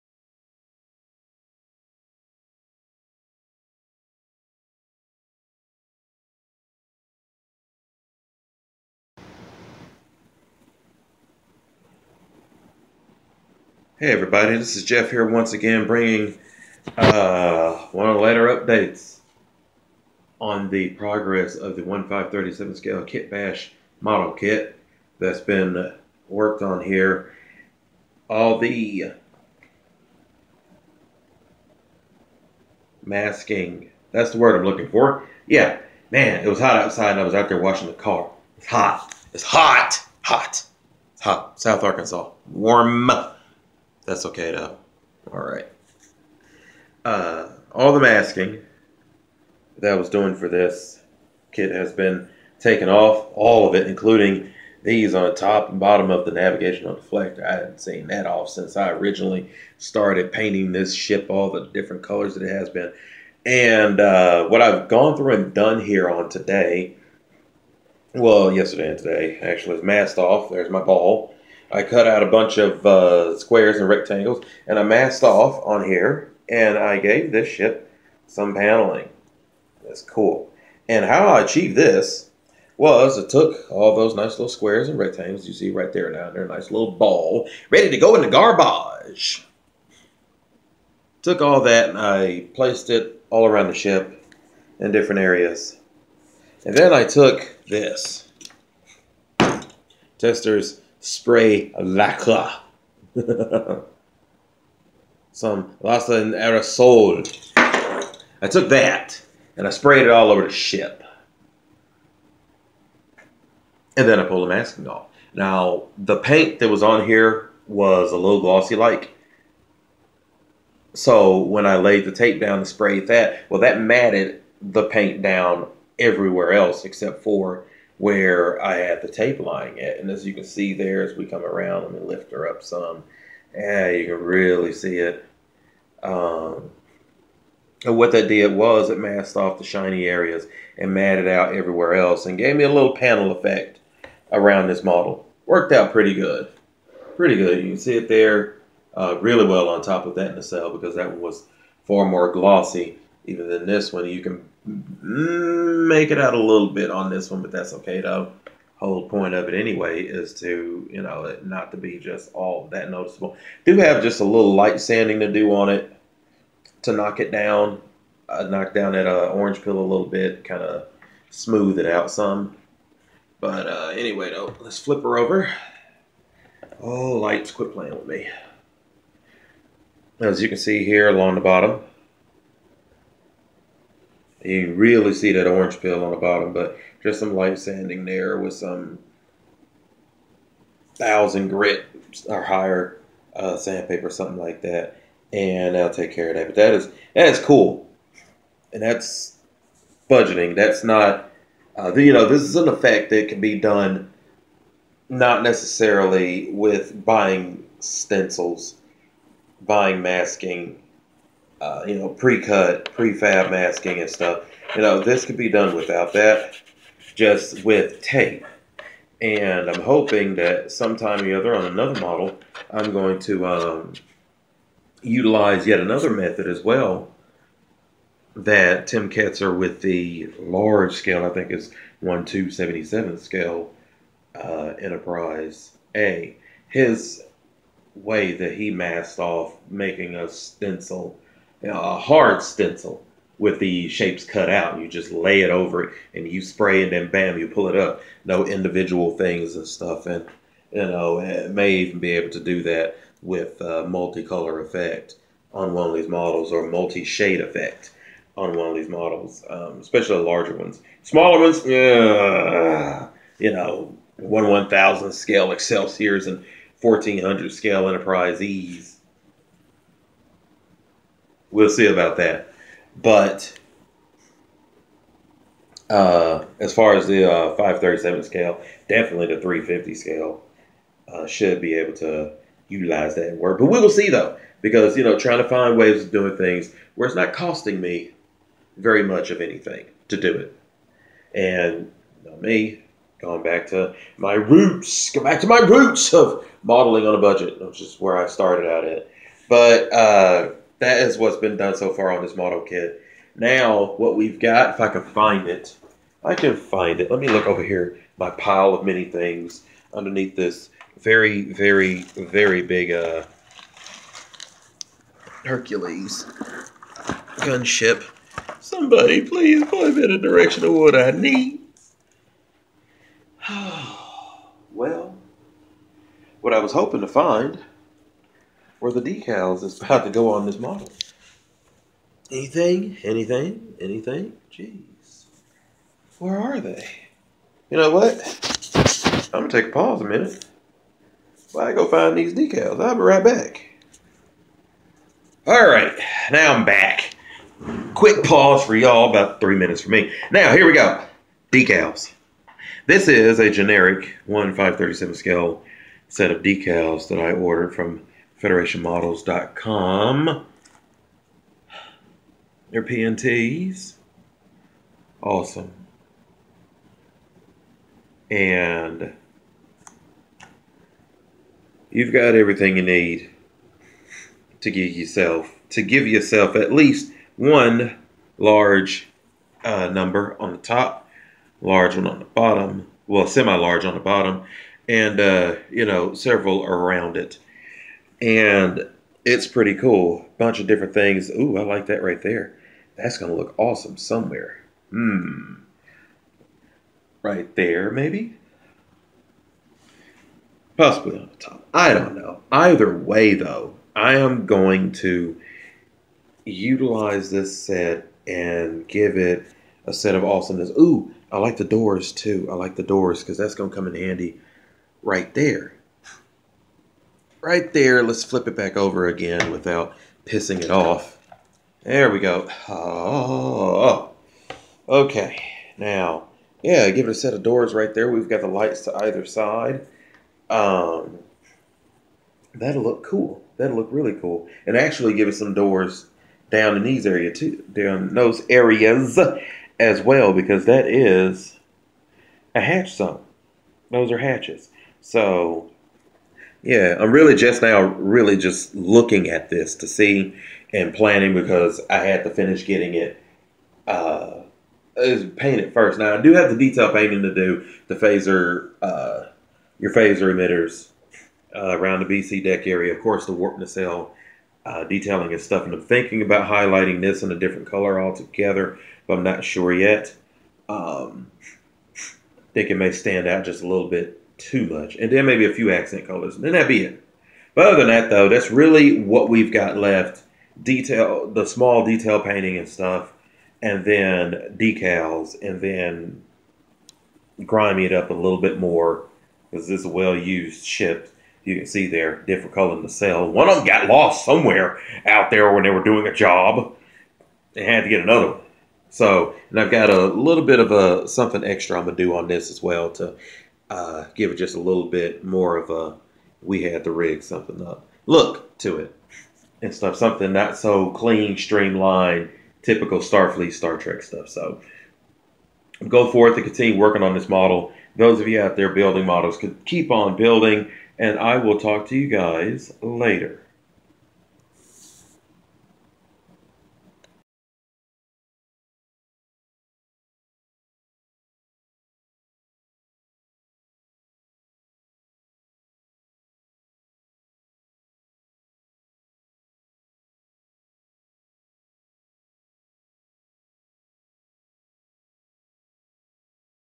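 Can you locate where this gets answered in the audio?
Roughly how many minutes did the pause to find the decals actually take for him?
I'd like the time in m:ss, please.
5:49.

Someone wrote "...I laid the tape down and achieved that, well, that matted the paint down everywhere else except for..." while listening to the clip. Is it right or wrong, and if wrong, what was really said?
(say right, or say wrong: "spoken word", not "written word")
wrong: "sprayed", not "achieved".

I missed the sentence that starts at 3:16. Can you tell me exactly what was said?
But that is that is cool, and that's budgeting.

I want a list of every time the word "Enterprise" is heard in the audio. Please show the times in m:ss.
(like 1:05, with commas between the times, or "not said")
3:54, 4:27.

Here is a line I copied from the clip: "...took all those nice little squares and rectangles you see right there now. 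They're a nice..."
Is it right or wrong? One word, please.
right.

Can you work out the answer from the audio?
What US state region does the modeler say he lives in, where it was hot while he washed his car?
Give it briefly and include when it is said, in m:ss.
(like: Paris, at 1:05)
South Arkansas, at 0:41.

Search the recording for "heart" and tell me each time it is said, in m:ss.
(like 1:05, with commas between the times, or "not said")
not said.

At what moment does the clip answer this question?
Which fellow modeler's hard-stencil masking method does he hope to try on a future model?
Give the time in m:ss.
3:48.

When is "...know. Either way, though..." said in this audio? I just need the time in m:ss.
6:42.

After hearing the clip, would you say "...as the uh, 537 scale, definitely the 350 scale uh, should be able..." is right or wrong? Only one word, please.
right.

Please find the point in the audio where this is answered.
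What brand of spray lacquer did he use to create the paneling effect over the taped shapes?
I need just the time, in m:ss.
1:40.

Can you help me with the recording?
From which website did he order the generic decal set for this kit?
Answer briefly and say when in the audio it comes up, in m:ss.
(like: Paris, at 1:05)
federationmodels.com, at 5:58.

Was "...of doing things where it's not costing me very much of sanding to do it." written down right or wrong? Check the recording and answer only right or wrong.
wrong.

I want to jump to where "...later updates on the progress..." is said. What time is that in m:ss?
0:18.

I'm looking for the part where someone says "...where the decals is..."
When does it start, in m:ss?
5:28.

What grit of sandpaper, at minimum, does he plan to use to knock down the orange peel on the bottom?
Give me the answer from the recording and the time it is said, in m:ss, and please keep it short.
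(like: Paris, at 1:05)
1000, at 3:10.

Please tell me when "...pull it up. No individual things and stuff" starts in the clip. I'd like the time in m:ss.
4:07.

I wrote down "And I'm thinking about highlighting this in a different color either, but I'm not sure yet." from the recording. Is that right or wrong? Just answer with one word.
wrong.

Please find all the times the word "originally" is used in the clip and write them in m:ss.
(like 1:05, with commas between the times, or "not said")
0:58.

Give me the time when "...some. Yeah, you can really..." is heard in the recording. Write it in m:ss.
2:12.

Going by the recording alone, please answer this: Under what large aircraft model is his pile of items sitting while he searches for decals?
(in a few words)
Hercules gunship.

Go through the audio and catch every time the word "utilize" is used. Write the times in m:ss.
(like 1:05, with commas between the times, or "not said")
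3:45, 4:42, 6:46.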